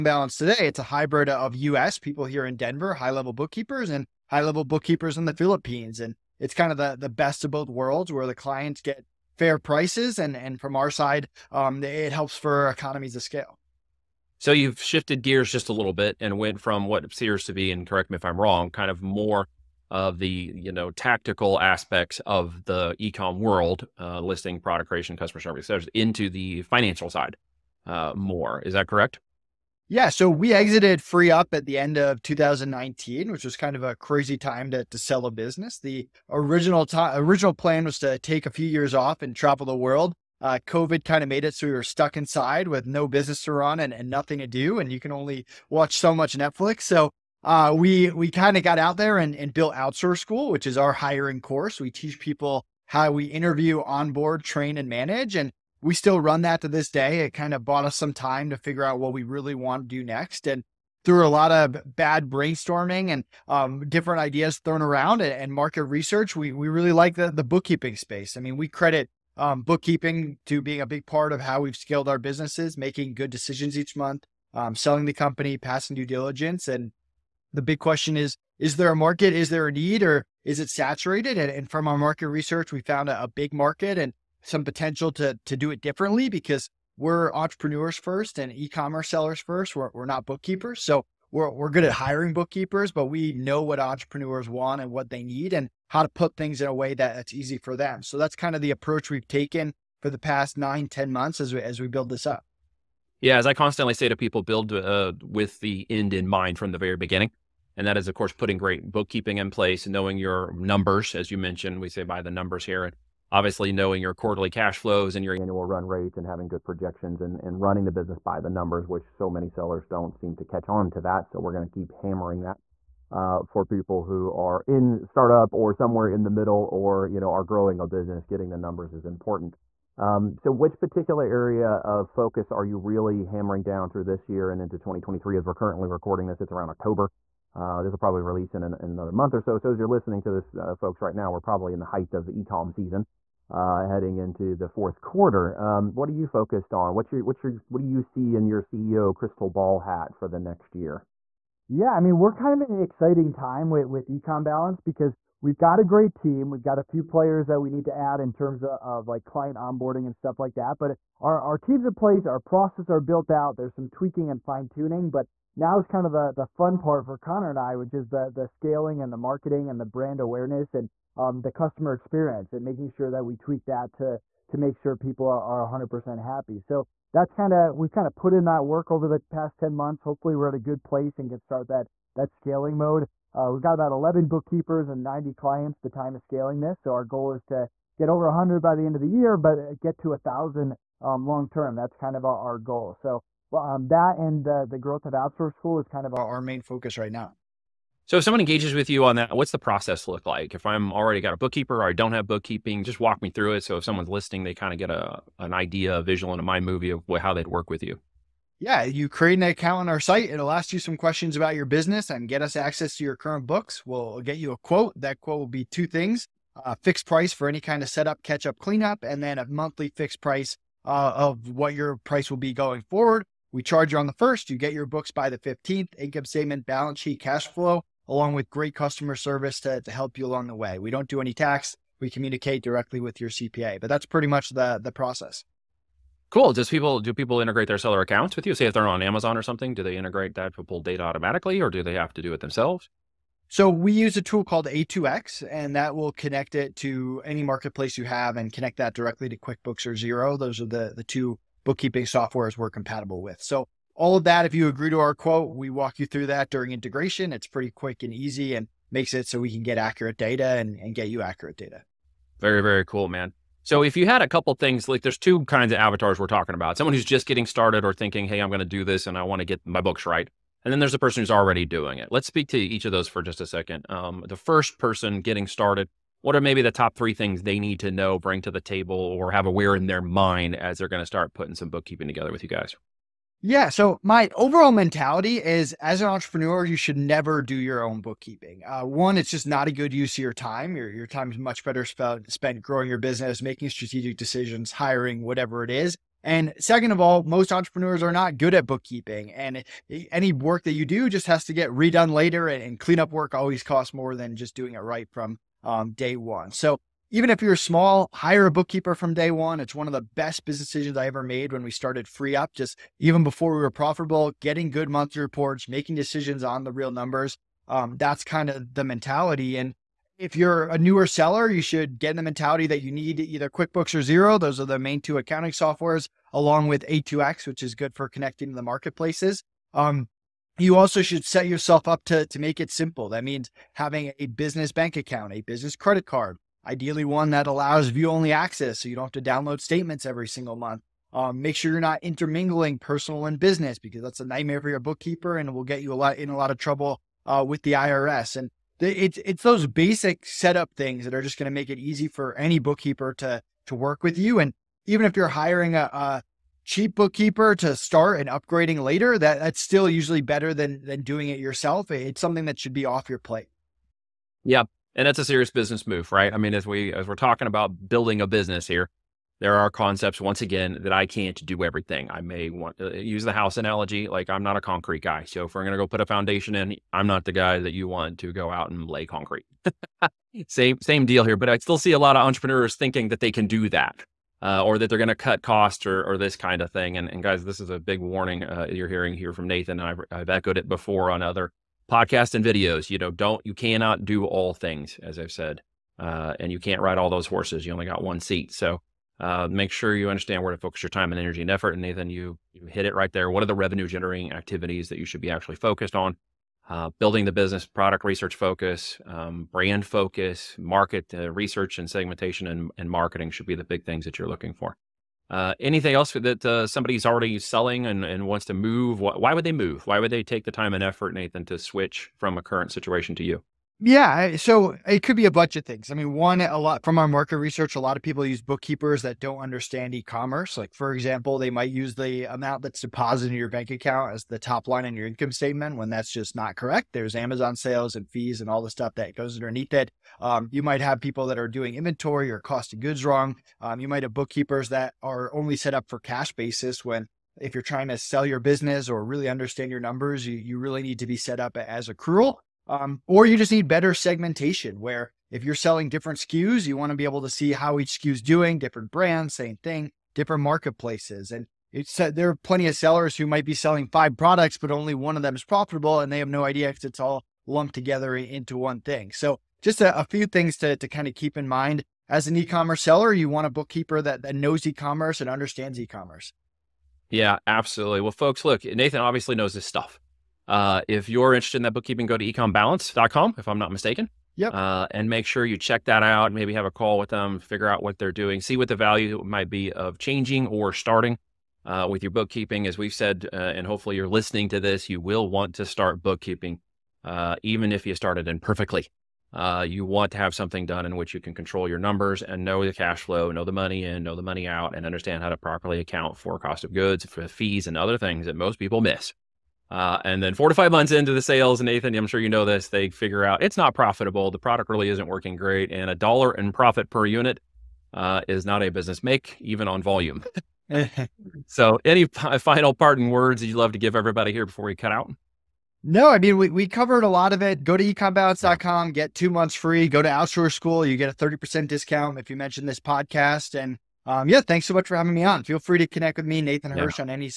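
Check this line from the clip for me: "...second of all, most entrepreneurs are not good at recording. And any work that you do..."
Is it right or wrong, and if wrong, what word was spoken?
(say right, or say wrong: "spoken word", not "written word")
wrong: "bookkeeping", not "recording".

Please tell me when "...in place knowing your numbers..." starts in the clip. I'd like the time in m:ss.
1:49.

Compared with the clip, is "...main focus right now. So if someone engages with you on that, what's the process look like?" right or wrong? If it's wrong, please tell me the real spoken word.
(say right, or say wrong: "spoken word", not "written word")
right.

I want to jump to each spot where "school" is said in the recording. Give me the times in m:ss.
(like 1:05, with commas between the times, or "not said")
0:50, 3:15, 8:50.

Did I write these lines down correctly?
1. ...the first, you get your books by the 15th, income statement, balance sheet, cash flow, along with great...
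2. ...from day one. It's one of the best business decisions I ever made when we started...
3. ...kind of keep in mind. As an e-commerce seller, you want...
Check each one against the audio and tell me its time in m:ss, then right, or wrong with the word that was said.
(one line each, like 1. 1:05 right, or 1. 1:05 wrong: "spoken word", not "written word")
1. 3:44 right
2. 5:08 right
3. 7:50 right.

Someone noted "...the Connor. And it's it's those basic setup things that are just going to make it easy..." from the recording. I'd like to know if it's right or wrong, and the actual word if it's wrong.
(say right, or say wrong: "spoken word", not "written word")
wrong: "IRS", not "Connor".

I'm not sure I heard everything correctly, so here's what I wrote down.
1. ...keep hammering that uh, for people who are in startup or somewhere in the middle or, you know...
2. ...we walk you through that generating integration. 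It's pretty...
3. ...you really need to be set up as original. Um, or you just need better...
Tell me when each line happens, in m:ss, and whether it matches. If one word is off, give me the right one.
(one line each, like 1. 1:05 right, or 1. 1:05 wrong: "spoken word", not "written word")
1. 2:01 right
2. 4:15 wrong: "during", not "generating"
3. 7:30 wrong: "accrual", not "original".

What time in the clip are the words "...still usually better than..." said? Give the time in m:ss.
5:59.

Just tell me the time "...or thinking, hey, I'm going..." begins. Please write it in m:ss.
4:27.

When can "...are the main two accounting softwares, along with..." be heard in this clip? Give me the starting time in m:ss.
5:24.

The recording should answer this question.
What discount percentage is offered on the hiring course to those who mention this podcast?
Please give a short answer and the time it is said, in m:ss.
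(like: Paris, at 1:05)
30%, at 8:51.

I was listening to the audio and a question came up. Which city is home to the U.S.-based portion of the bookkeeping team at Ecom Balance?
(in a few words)
Denver.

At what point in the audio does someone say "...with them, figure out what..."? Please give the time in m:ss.
8:06.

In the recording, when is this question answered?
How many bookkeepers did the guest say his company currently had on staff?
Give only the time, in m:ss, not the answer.
3:03.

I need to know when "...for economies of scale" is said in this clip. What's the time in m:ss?
0:12.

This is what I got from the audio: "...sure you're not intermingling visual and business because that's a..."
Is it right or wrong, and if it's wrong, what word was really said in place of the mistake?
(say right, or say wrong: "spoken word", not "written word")
wrong: "personal", not "visual".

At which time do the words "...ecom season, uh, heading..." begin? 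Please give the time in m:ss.
2:22.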